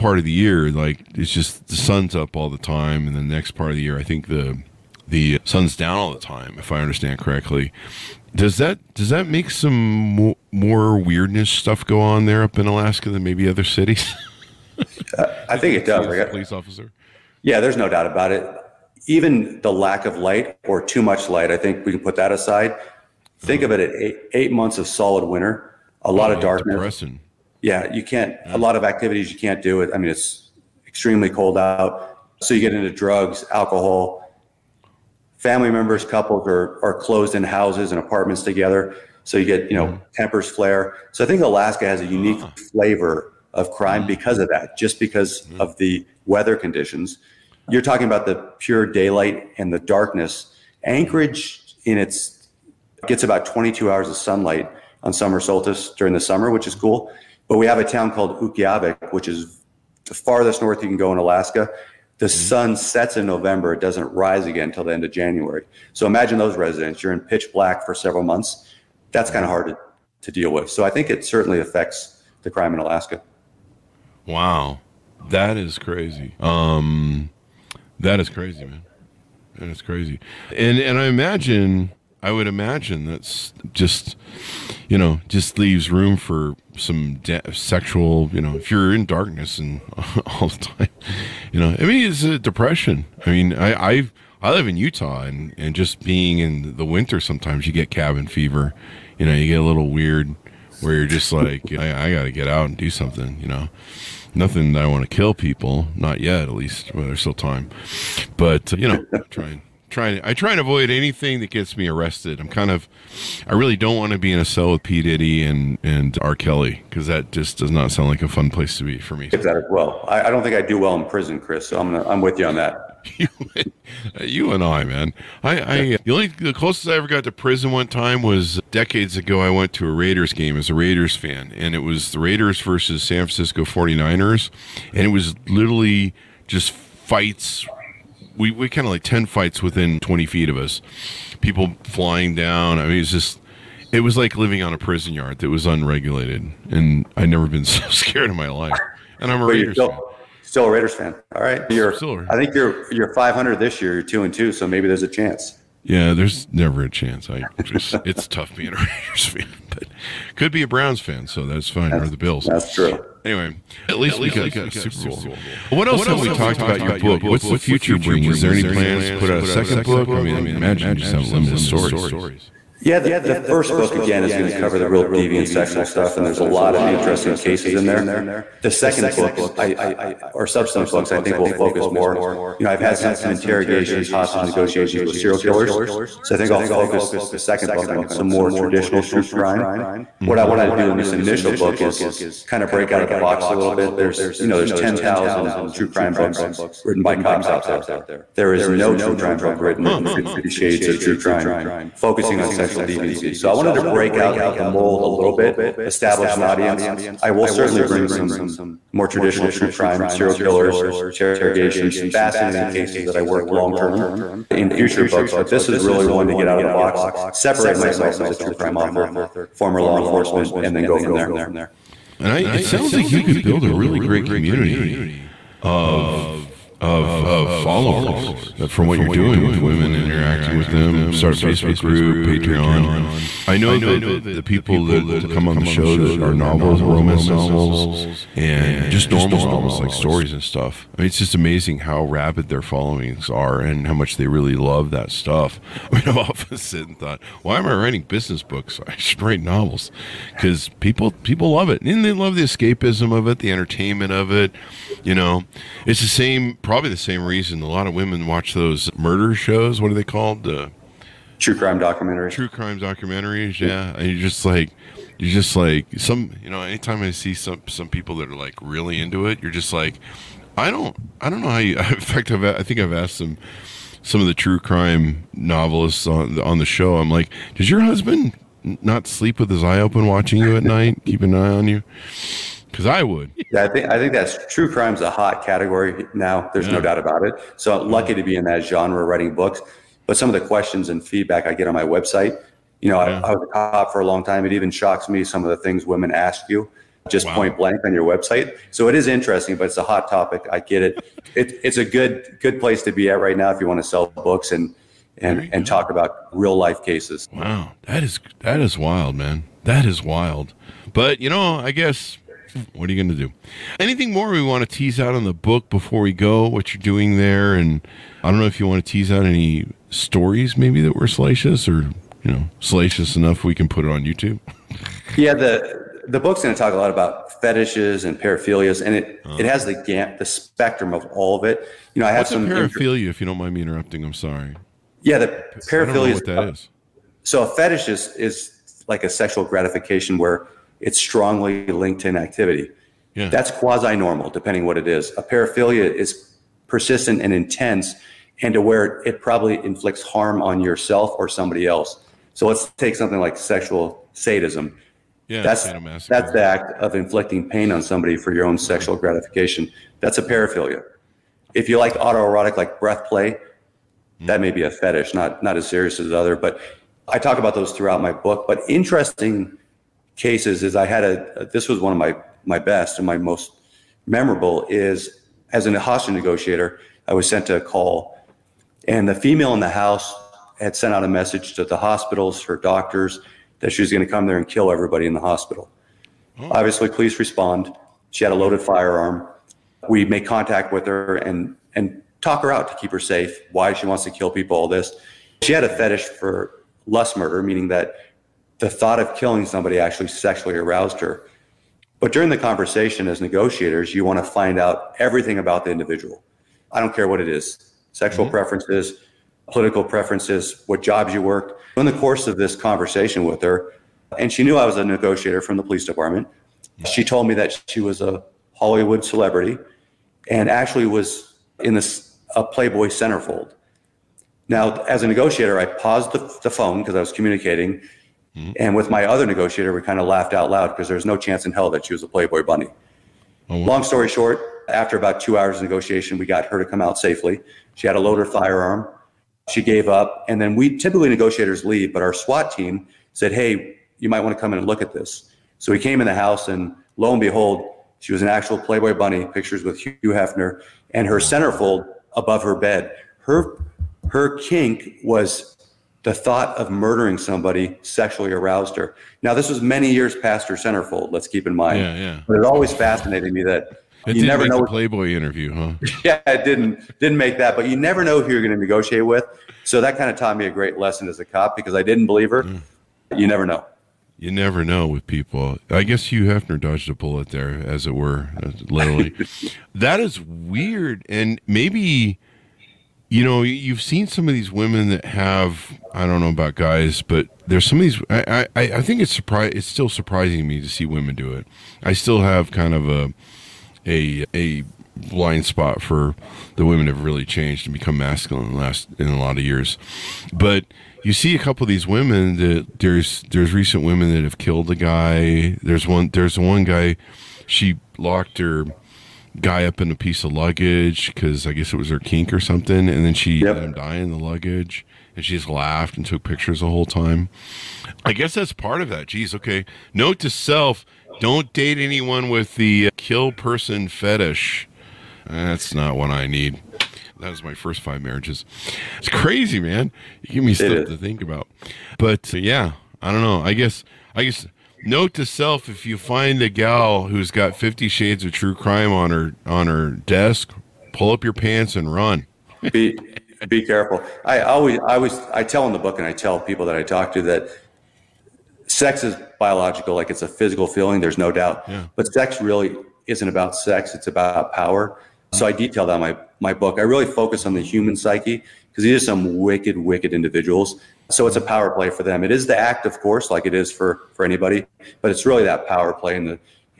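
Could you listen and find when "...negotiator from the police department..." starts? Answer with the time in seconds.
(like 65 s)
414 s.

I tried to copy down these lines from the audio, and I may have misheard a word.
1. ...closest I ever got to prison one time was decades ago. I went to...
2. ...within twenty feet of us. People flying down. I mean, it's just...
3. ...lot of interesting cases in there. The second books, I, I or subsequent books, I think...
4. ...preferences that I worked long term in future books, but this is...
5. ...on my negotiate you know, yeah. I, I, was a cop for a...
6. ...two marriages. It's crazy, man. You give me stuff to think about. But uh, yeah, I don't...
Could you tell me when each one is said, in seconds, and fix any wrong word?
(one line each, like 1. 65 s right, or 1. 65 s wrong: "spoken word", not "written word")
1. 126 s right
2. 139 s right
3. 176 s right
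4. 212 s wrong: "cases", not "preferences"
5. 291 s wrong: "website", not "negotiate"
6. 527 s wrong: "five", not "two".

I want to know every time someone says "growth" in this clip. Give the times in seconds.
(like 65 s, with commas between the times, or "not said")
not said.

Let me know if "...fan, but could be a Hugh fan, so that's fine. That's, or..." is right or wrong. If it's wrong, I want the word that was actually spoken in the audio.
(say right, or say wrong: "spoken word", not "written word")
wrong: "Browns", not "Hugh".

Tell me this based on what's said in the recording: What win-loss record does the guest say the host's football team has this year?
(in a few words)
2 and 2.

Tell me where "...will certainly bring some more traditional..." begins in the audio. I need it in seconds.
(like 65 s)
207 s.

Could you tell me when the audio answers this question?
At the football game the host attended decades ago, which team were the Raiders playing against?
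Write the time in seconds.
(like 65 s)
133 s.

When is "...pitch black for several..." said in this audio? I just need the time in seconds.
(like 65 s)
67 s.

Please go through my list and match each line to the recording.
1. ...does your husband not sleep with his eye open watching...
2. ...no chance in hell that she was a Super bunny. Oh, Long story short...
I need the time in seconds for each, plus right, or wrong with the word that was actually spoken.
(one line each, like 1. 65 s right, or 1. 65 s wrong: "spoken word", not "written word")
1. 277 s right
2. 431 s wrong: "Playboy", not "Super".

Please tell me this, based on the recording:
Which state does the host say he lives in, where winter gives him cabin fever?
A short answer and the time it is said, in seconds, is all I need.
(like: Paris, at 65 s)
Utah, at 94 s.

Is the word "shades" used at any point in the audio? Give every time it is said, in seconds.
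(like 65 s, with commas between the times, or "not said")
200 s, 537 s.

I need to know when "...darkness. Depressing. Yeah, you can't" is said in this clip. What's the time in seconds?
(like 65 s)
26 s.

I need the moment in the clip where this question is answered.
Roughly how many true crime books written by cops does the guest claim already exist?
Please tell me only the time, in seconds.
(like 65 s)
194 s.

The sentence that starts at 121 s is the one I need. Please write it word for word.
So I'm gonna, I'm with you on that.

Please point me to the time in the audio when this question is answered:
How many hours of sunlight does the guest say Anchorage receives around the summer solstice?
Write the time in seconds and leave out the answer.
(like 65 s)
53 s.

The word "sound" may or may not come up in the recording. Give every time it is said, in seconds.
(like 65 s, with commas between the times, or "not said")
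117 s, 222 s.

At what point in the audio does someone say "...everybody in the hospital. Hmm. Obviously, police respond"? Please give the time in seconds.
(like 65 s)
384 s.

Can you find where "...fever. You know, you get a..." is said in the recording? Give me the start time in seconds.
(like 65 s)
98 s.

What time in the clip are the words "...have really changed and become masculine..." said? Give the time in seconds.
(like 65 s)
496 s.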